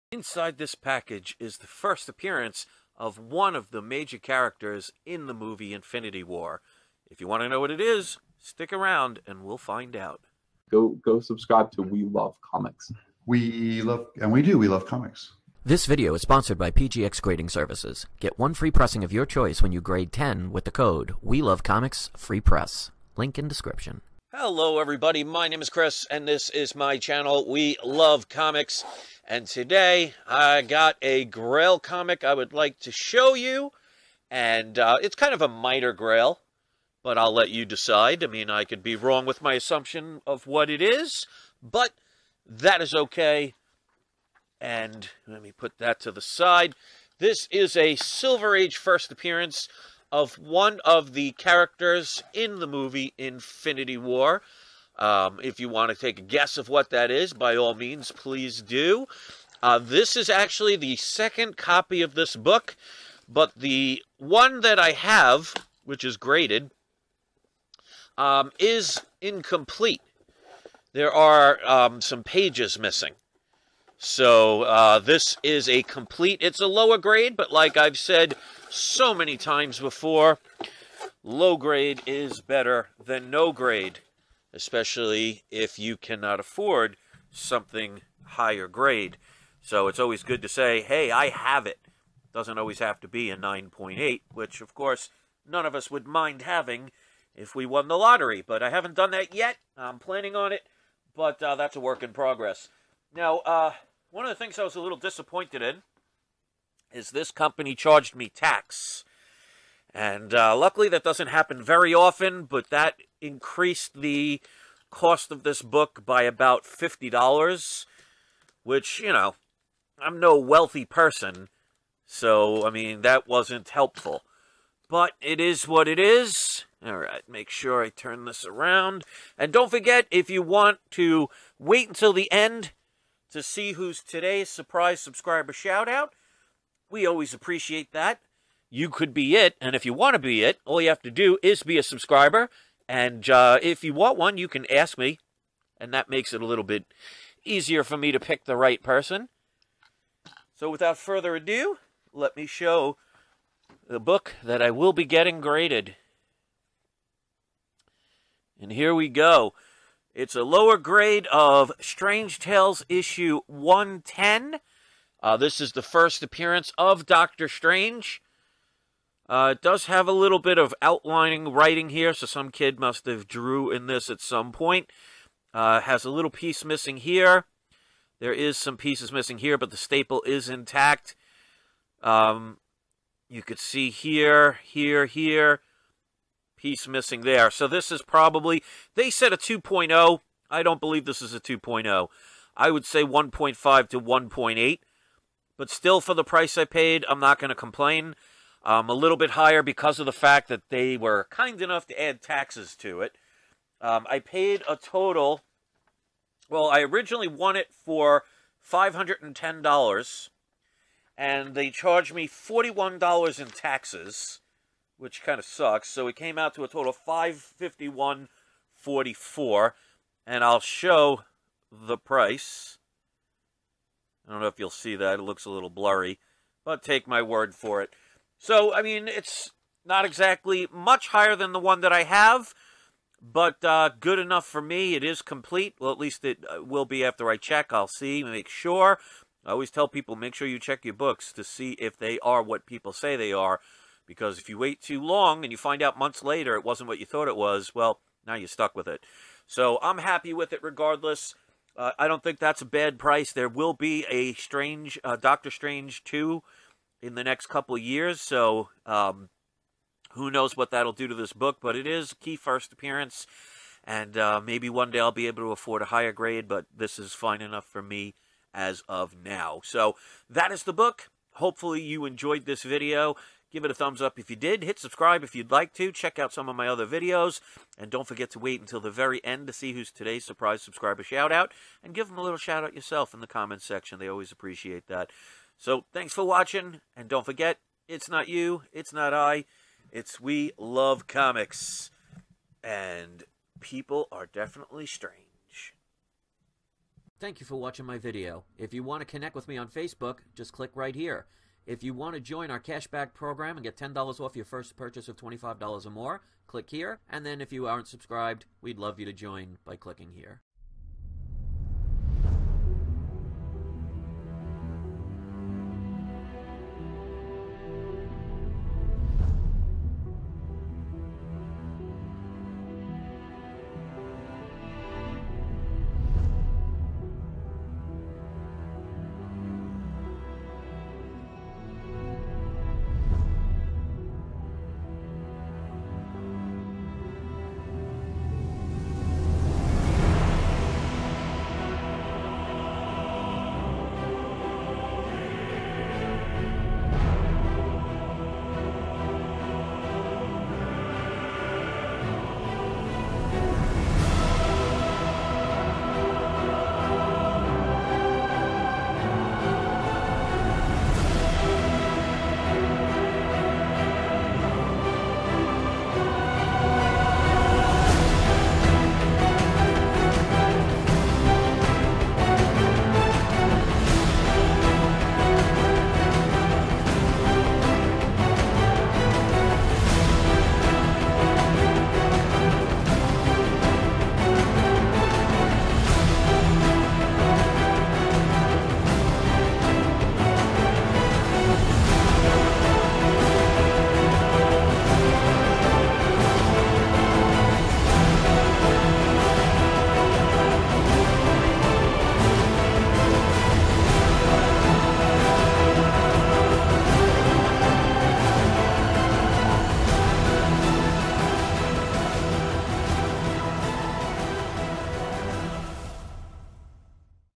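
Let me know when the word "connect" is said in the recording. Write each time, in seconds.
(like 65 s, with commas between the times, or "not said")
299 s.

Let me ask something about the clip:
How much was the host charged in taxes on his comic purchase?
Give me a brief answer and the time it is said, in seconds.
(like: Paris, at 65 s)
$41, at 212 s.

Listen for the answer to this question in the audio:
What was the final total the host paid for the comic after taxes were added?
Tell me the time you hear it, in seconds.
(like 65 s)
217 s.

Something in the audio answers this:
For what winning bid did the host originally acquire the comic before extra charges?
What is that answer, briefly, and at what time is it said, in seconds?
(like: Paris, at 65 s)
$510, at 208 s.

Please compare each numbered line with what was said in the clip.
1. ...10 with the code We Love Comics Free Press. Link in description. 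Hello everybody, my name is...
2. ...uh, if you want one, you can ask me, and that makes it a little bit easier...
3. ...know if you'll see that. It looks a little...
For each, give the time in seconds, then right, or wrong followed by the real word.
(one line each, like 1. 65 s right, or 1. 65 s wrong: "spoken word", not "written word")
1. 20 s right
2. 143 s right
3. 224 s right.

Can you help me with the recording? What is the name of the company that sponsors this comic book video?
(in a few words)
PGX Grading Services.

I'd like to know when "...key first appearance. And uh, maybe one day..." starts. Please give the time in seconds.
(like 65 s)
262 s.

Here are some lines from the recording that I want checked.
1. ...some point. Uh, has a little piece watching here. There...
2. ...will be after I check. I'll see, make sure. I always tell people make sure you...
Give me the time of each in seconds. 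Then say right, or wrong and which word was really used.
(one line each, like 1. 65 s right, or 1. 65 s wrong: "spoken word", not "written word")
1. 174 s wrong: "missing", not "watching"
2. 236 s right.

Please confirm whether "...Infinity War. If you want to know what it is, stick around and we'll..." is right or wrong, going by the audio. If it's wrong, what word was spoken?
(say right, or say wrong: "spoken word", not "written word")
right.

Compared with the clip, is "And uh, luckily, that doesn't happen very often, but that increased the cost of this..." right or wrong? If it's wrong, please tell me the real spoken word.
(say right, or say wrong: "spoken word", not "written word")
right.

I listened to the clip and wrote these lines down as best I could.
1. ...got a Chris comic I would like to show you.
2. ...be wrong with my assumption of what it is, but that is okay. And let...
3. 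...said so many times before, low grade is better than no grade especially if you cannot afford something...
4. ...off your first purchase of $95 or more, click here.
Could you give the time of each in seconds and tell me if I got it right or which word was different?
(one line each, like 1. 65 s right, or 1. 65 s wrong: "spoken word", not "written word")
1. 30 s wrong: "Grail", not "Chris"
2. 38 s right
3. 77 s right
4. 304 s wrong: "25", not "95".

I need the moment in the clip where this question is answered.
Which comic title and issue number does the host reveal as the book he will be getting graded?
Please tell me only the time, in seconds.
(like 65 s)
161 s.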